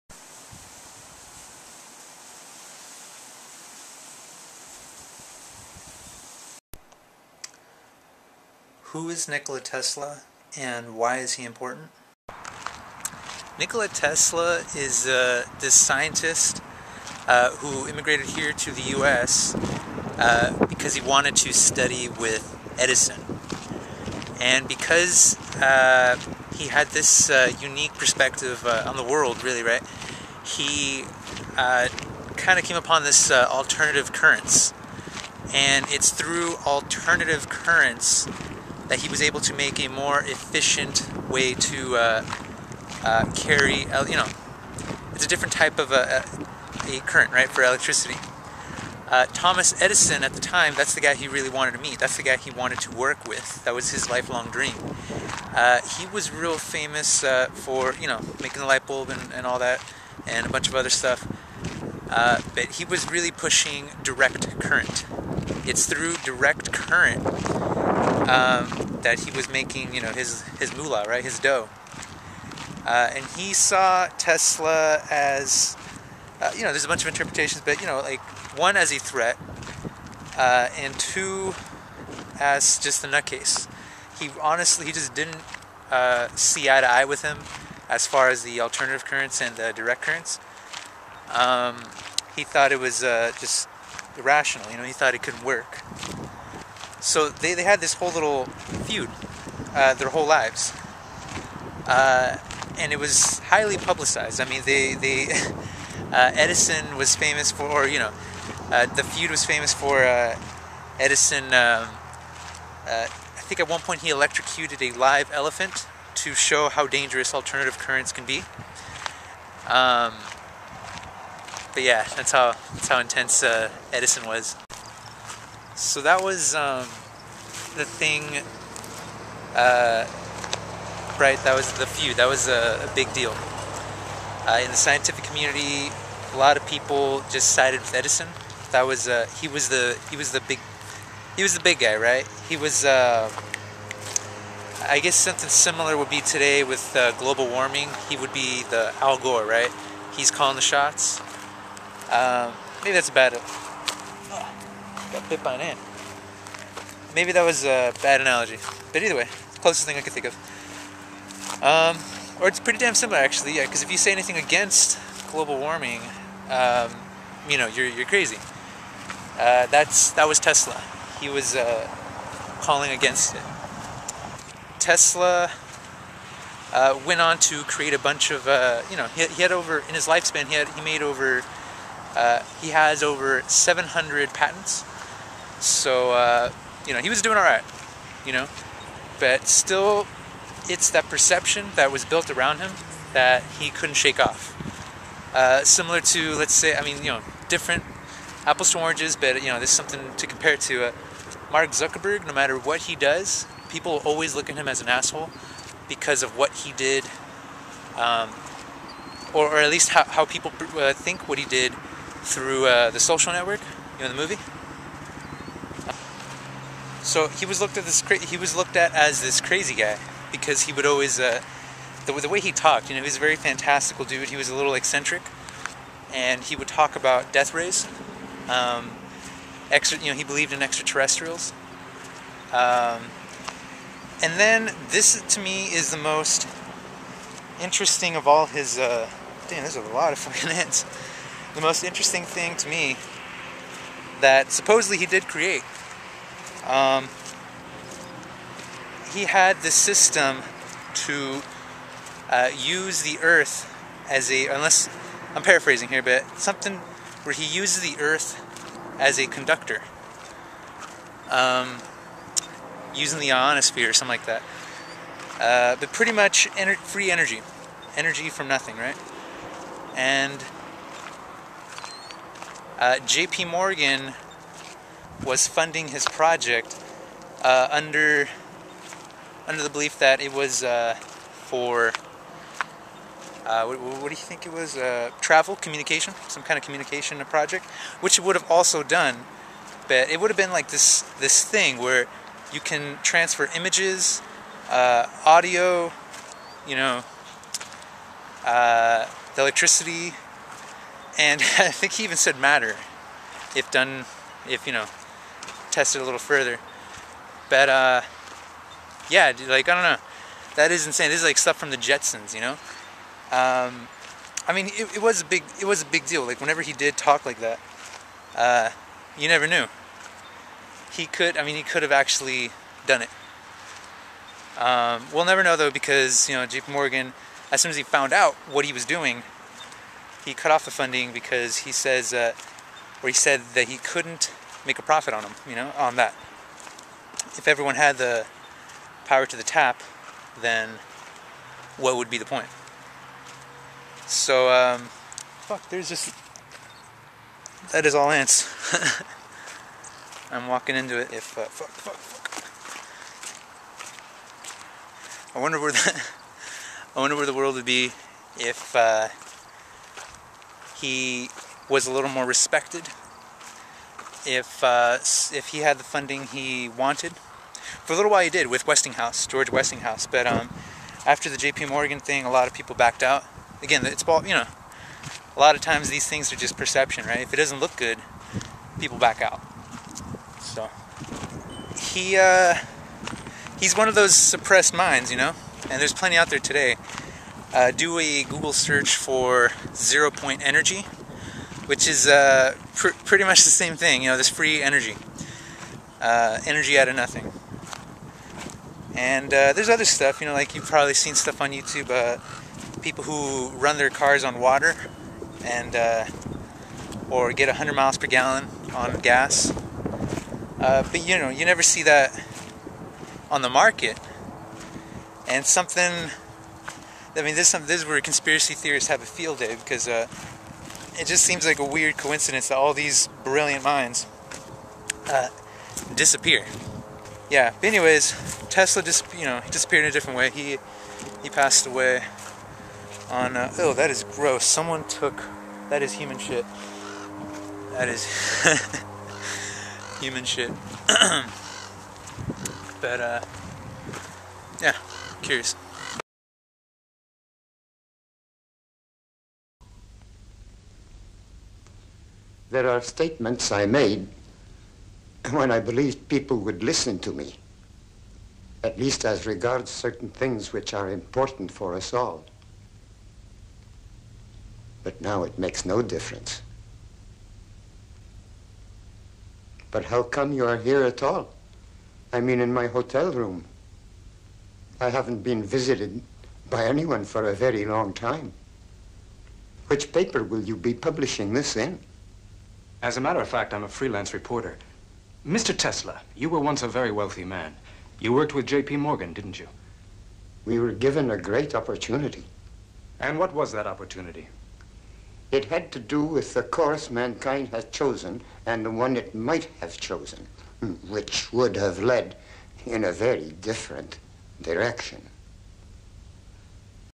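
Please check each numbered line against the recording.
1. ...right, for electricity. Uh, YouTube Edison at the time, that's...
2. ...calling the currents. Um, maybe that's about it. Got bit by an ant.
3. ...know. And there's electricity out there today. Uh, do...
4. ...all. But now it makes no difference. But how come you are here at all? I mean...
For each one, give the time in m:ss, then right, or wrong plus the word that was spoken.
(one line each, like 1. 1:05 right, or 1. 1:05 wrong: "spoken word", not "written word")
1. 0:47 wrong: "Thomas", not "YouTube"
2. 2:30 wrong: "shots", not "currents"
3. 6:25 wrong: "plenty", not "electricity"
4. 7:41 right.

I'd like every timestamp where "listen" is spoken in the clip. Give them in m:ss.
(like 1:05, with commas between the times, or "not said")
7:36.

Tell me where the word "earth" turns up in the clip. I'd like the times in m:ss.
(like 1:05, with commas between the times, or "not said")
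4:13, 4:18.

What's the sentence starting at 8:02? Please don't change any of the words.
As a matter of fact, I'm a freelance reporter.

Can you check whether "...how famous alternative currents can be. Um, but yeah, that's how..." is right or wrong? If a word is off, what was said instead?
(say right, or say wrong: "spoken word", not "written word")
wrong: "dangerous", not "famous".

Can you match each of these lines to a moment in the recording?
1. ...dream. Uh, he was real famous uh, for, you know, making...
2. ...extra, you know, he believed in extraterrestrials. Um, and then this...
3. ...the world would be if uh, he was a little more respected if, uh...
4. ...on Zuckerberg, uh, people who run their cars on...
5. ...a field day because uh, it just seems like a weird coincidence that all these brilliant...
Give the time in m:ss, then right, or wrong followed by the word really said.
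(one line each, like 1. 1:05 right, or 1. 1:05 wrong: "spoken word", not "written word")
1. 0:54 right
2. 3:49 right
3. 5:57 right
4. 6:41 wrong: "YouTube", not "Zuckerberg"
5. 6:59 right.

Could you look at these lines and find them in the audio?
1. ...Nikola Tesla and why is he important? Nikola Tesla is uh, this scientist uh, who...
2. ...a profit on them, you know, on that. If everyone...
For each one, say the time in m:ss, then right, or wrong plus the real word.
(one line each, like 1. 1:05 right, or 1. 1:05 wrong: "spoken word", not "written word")
1. 0:09 right
2. 5:34 right.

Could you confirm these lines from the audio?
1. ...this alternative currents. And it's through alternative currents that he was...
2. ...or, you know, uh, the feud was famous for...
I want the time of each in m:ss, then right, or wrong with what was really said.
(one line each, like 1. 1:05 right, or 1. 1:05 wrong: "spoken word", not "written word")
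1. 0:33 right
2. 1:47 right.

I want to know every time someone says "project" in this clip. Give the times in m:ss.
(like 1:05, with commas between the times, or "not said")
4:36, 4:47.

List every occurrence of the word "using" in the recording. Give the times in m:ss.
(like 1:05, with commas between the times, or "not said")
4:22.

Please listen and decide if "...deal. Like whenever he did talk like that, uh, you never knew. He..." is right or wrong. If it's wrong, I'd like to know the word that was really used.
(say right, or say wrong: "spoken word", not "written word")
right.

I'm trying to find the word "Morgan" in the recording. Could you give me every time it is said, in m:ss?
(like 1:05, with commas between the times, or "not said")
4:33, 5:26, 6:11, 8:08.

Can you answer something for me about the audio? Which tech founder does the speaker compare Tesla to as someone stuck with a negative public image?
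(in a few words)
Mark Zuckerberg.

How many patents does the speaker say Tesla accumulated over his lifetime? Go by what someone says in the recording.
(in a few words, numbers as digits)
over 700.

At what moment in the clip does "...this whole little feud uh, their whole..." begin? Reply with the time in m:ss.
1:37.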